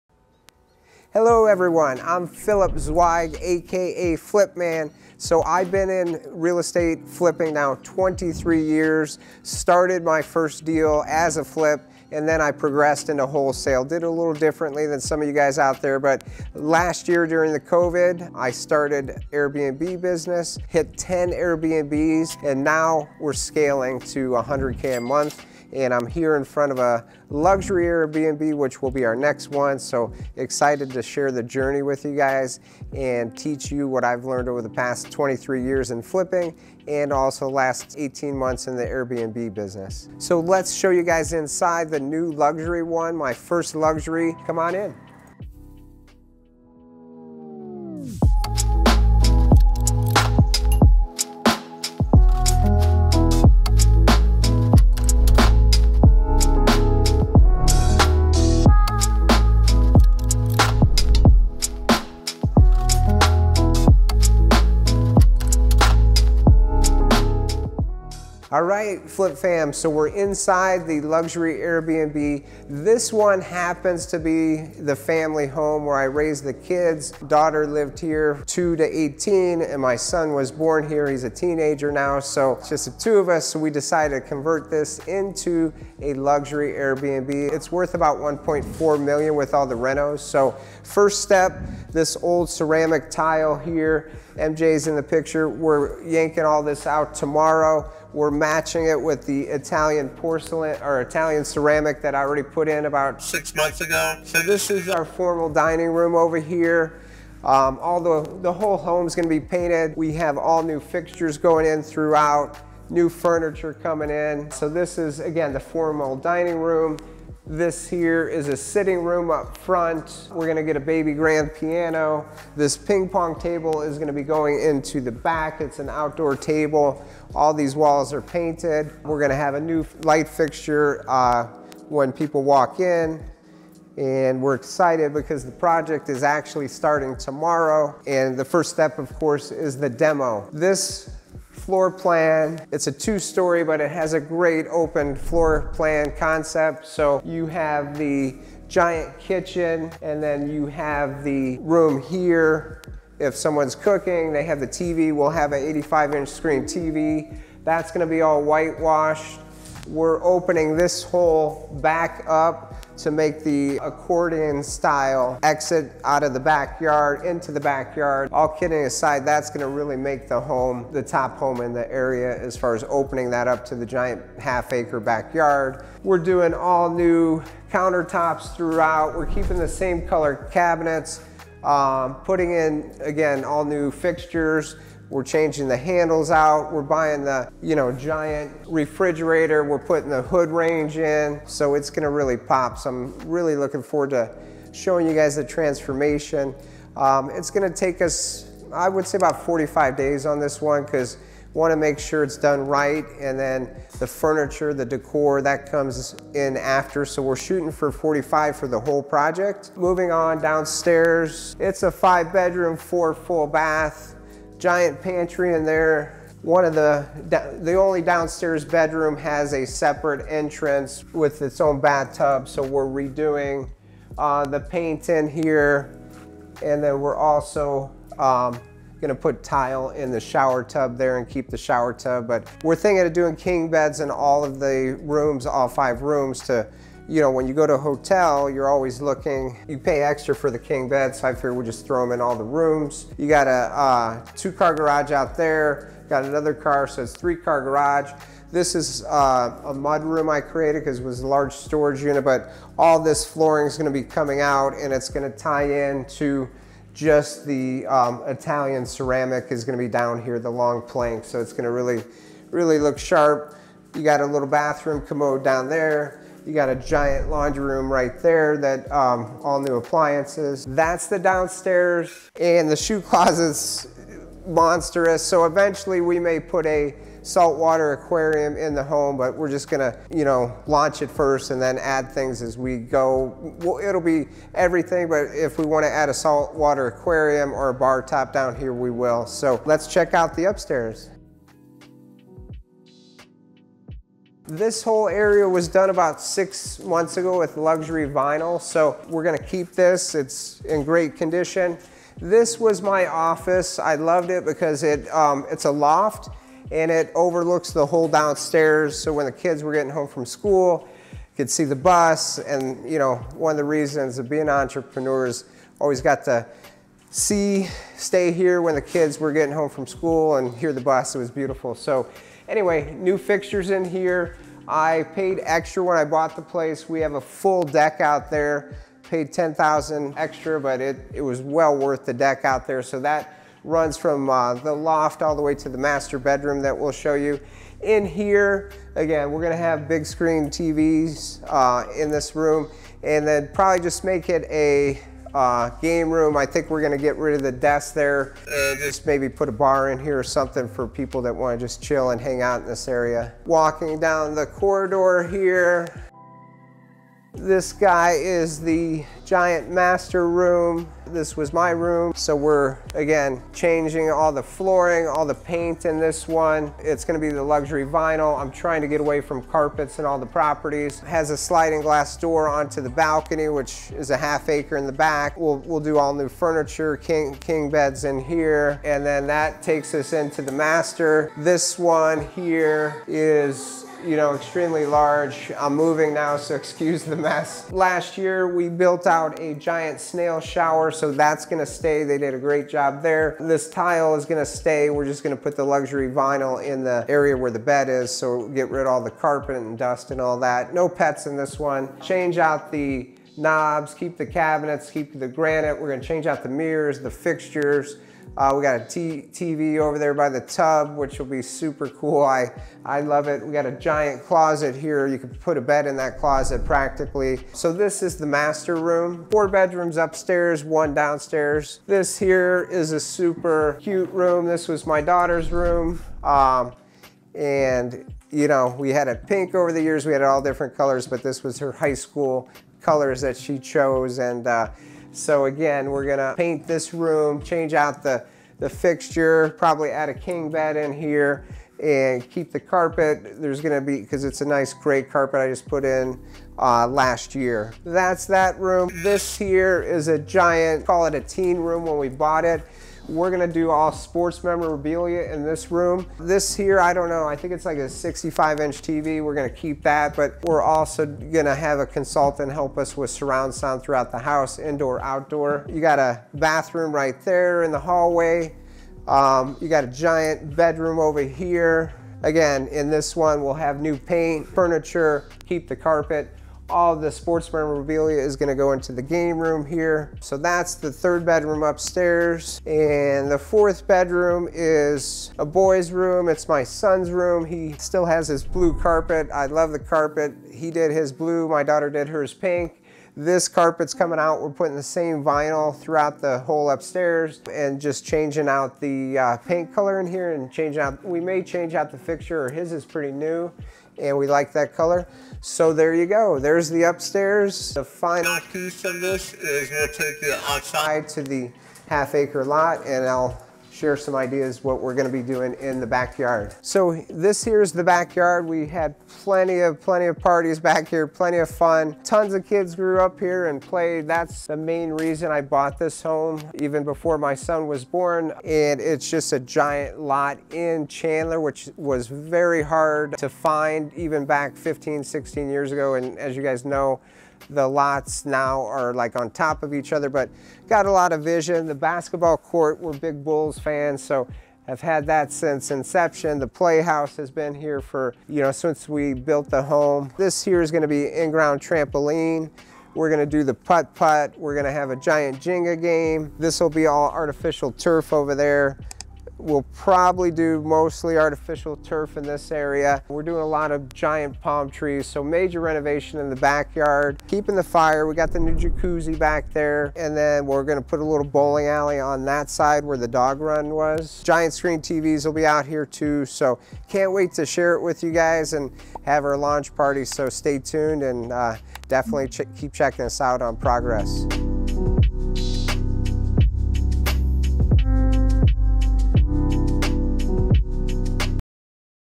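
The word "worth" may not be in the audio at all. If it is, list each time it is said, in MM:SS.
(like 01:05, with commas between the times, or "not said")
01:27, 05:31.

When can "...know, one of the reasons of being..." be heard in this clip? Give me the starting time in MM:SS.
05:12.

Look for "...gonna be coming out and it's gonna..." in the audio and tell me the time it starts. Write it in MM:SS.
04:13.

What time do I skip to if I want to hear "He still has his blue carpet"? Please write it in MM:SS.
08:07.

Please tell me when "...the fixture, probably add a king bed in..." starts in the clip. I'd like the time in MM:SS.
07:18.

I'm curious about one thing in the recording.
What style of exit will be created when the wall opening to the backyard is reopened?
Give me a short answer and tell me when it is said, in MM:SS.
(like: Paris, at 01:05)
accordion style, at 02:43.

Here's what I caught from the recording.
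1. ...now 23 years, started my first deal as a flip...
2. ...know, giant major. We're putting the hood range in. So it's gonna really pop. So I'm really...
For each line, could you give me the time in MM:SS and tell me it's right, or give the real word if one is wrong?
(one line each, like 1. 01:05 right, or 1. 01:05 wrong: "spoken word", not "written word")
1. 00:07 right
2. 03:07 wrong: "refrigerator", not "major".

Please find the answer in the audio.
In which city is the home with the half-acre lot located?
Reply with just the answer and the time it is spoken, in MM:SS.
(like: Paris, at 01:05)
Chandler, at 08:50.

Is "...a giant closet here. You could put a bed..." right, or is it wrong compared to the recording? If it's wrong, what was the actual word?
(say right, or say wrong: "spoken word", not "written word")
right.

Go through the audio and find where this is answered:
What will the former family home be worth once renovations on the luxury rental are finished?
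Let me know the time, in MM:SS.
01:28.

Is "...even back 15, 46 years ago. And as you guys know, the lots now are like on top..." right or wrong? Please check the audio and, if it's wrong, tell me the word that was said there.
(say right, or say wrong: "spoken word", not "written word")
wrong: "16", not "46".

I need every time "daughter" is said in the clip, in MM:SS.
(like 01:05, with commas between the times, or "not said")
01:17, 07:05, 08:11.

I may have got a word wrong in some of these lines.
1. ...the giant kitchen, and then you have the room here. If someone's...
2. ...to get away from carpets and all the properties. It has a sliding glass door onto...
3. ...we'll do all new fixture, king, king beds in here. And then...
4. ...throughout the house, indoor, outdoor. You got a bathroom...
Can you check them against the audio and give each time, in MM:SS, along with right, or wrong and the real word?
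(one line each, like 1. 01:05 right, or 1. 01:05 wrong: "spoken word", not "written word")
1. 02:27 right
2. 06:08 right
3. 06:15 wrong: "furniture", not "fixture"
4. 07:43 right.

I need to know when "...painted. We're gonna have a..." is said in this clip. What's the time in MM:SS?
02:08.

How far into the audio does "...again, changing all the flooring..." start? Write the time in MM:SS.
06:02.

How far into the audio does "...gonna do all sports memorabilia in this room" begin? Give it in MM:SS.
07:33.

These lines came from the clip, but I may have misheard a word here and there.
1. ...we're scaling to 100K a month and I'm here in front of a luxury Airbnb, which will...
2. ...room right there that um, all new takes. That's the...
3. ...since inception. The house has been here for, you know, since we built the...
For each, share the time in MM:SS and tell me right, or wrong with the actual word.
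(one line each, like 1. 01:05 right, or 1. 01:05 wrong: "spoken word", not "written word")
1. 00:23 right
2. 04:27 wrong: "appliances", not "takes"
3. 09:05 wrong: "playhouse", not "house".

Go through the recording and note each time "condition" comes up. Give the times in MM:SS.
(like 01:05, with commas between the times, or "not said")
05:01.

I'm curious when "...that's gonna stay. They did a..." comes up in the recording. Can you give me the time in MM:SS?
06:31.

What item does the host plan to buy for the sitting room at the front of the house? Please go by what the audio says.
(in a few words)
baby grand piano.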